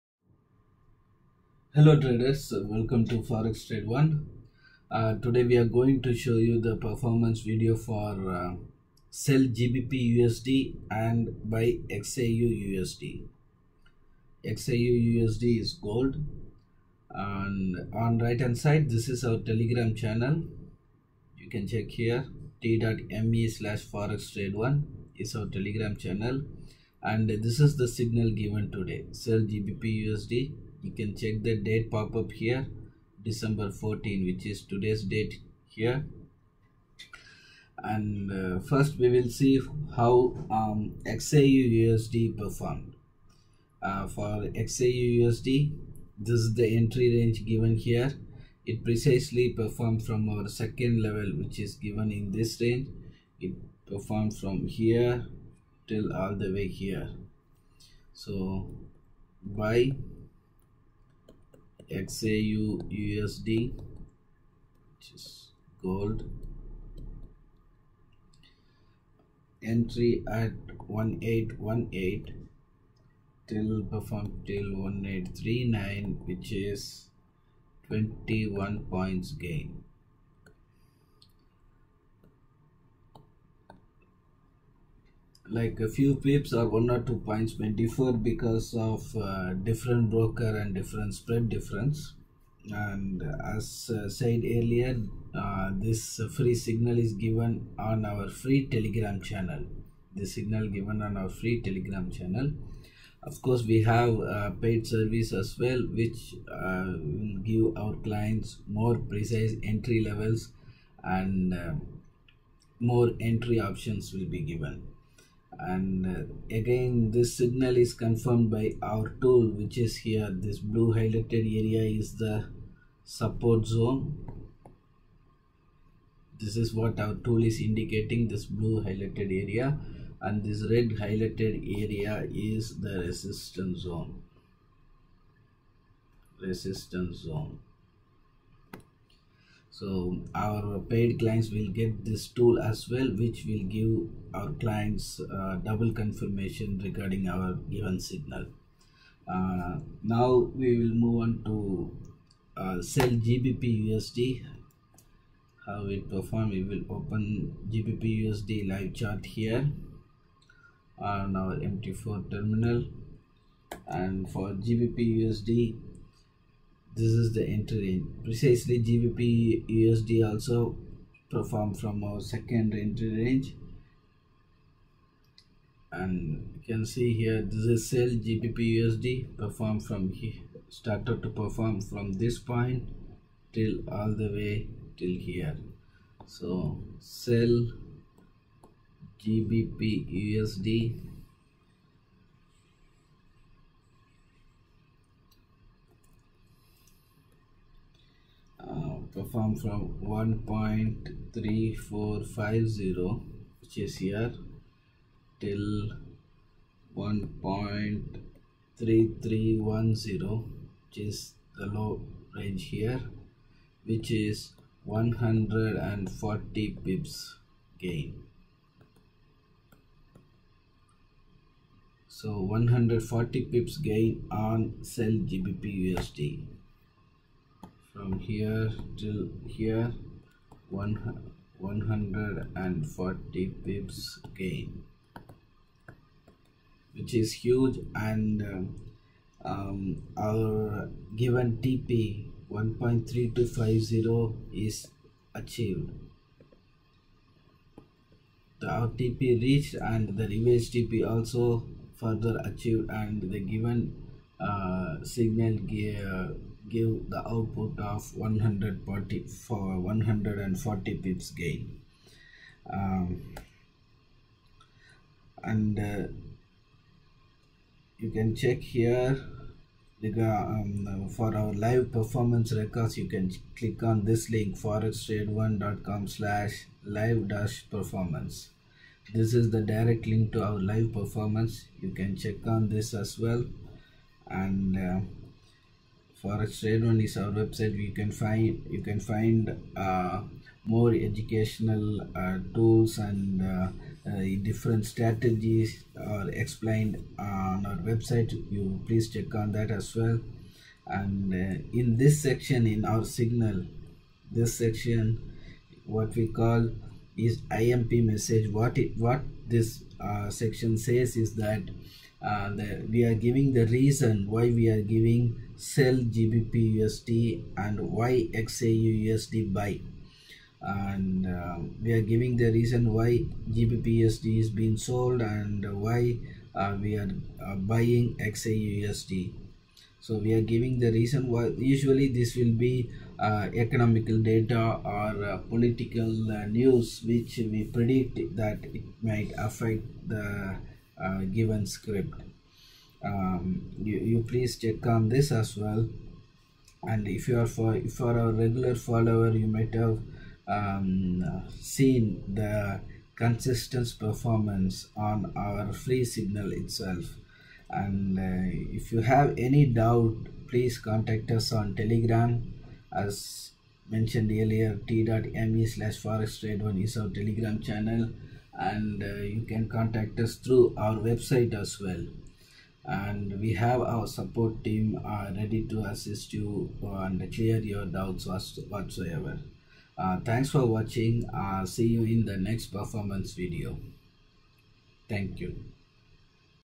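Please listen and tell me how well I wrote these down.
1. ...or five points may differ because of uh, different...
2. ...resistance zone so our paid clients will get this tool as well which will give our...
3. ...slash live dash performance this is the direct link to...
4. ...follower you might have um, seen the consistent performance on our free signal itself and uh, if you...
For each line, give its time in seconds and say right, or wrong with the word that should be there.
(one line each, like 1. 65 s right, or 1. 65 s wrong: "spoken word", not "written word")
1. 86 s wrong: "two", not "five"
2. 136 s right
3. 276 s right
4. 348 s right.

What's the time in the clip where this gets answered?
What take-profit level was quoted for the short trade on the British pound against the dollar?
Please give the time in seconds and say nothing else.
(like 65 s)
242 s.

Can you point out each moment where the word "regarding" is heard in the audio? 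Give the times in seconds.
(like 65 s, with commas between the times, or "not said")
146 s.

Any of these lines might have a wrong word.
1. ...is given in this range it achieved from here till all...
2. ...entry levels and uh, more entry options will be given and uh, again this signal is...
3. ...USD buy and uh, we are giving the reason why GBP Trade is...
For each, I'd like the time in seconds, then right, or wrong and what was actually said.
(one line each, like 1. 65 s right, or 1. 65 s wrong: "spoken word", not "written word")
1. 51 s wrong: "performed", not "achieved"
2. 109 s right
3. 319 s wrong: "USD", not "Trade".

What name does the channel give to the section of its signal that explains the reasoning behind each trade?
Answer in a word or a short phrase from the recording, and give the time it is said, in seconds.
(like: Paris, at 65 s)
IMP message, at 307 s.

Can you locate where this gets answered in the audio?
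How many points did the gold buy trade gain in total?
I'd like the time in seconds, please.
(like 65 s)
77 s.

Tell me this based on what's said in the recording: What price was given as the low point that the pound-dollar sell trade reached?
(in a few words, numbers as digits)
1.3310.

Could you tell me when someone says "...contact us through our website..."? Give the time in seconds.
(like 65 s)
369 s.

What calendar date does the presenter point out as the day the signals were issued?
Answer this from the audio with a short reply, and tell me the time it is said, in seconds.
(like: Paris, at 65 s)
December 14, at 33 s.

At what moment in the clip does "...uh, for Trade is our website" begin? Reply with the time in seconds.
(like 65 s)
284 s.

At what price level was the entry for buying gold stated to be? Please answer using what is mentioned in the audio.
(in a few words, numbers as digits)
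1818.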